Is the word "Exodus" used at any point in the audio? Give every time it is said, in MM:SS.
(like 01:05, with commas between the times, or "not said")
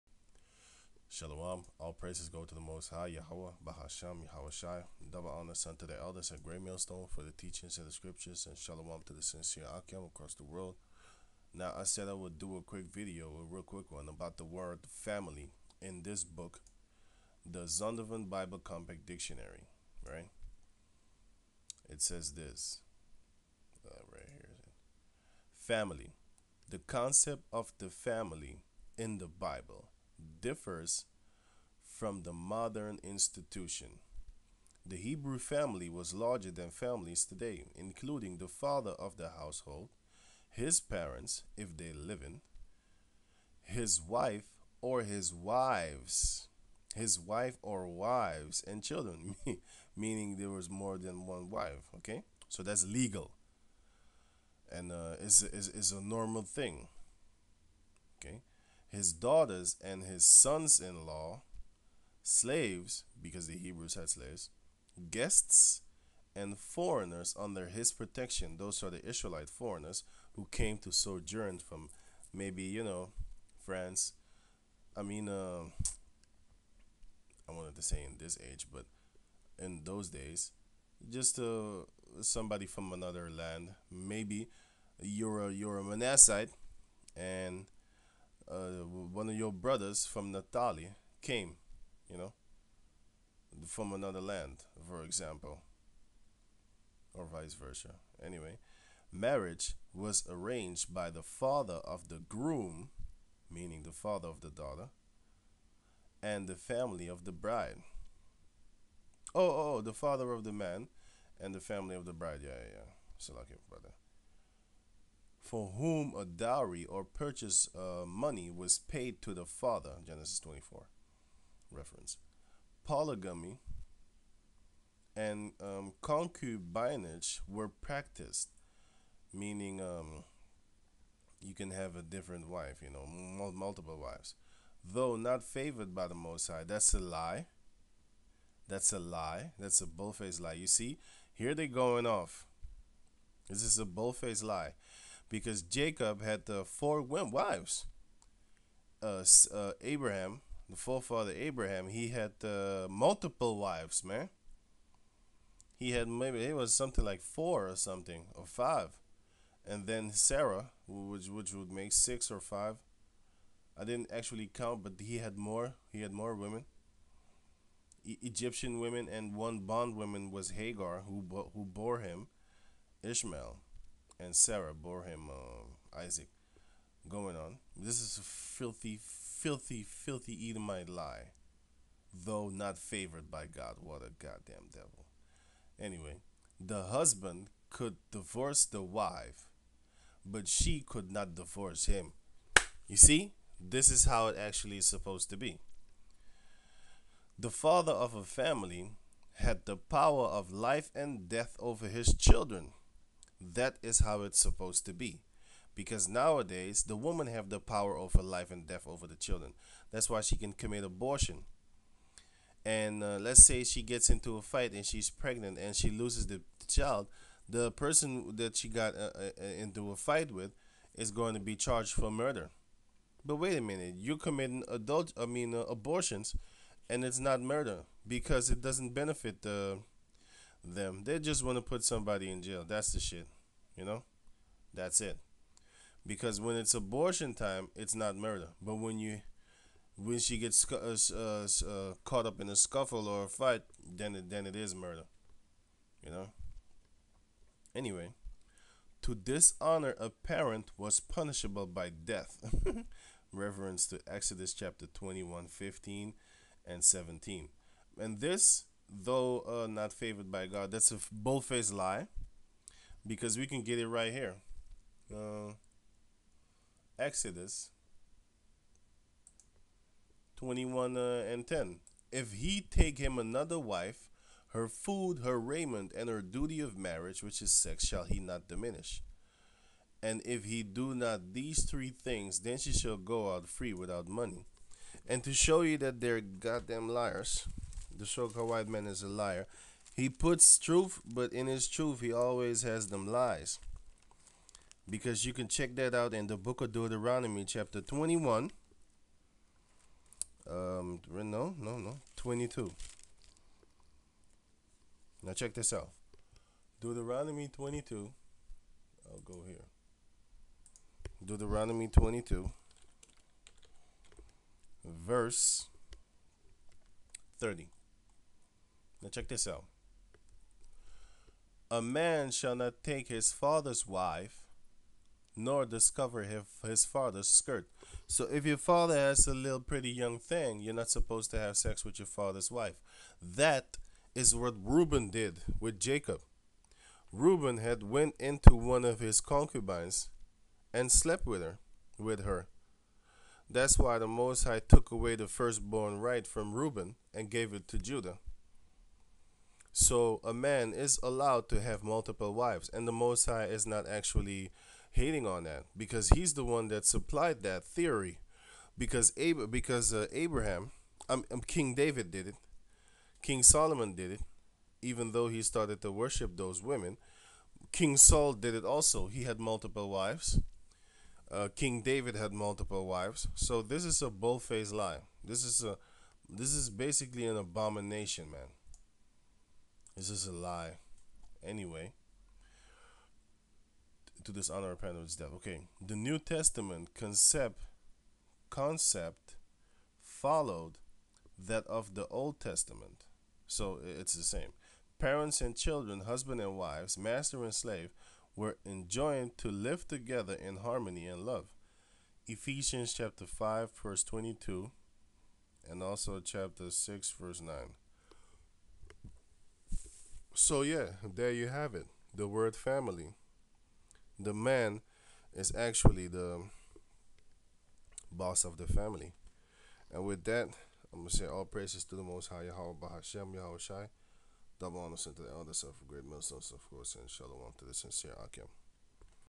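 04:14, 04:26.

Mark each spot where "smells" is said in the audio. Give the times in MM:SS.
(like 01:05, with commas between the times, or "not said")
not said.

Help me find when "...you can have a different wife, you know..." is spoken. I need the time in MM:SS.
02:11.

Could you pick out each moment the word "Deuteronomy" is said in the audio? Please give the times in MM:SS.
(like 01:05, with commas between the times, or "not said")
04:56, 05:06, 05:11.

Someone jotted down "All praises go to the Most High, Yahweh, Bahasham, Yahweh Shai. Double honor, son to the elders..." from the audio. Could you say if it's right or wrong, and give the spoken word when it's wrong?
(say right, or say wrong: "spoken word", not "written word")
right.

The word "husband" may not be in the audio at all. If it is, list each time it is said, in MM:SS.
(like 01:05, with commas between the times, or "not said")
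03:06, 06:36.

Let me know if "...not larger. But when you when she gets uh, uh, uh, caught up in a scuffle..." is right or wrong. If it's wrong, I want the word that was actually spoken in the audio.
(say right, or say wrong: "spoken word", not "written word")
wrong: "murder", not "larger".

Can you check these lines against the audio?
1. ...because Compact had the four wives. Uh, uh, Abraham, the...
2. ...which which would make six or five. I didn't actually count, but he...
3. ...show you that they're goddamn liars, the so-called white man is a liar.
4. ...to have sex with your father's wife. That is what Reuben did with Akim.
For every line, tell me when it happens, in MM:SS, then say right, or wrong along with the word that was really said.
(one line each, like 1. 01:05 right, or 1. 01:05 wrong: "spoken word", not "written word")
1. 02:25 wrong: "Jacob", not "Compact"
2. 02:40 right
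3. 04:45 right
4. 05:31 wrong: "Jacob", not "Akim".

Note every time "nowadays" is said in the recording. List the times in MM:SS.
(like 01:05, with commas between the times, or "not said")
03:26.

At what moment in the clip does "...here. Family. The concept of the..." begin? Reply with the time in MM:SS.
00:24.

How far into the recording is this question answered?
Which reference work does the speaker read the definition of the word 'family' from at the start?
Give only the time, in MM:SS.
00:17.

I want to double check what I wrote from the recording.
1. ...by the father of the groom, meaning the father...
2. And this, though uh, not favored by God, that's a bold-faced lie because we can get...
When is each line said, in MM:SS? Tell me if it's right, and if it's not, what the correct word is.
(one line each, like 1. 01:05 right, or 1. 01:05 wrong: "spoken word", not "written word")
1. 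01:40 right
2. 04:17 right.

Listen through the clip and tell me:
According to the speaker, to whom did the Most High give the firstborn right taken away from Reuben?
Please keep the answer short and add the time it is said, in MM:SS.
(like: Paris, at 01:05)
Judah, at 05:47.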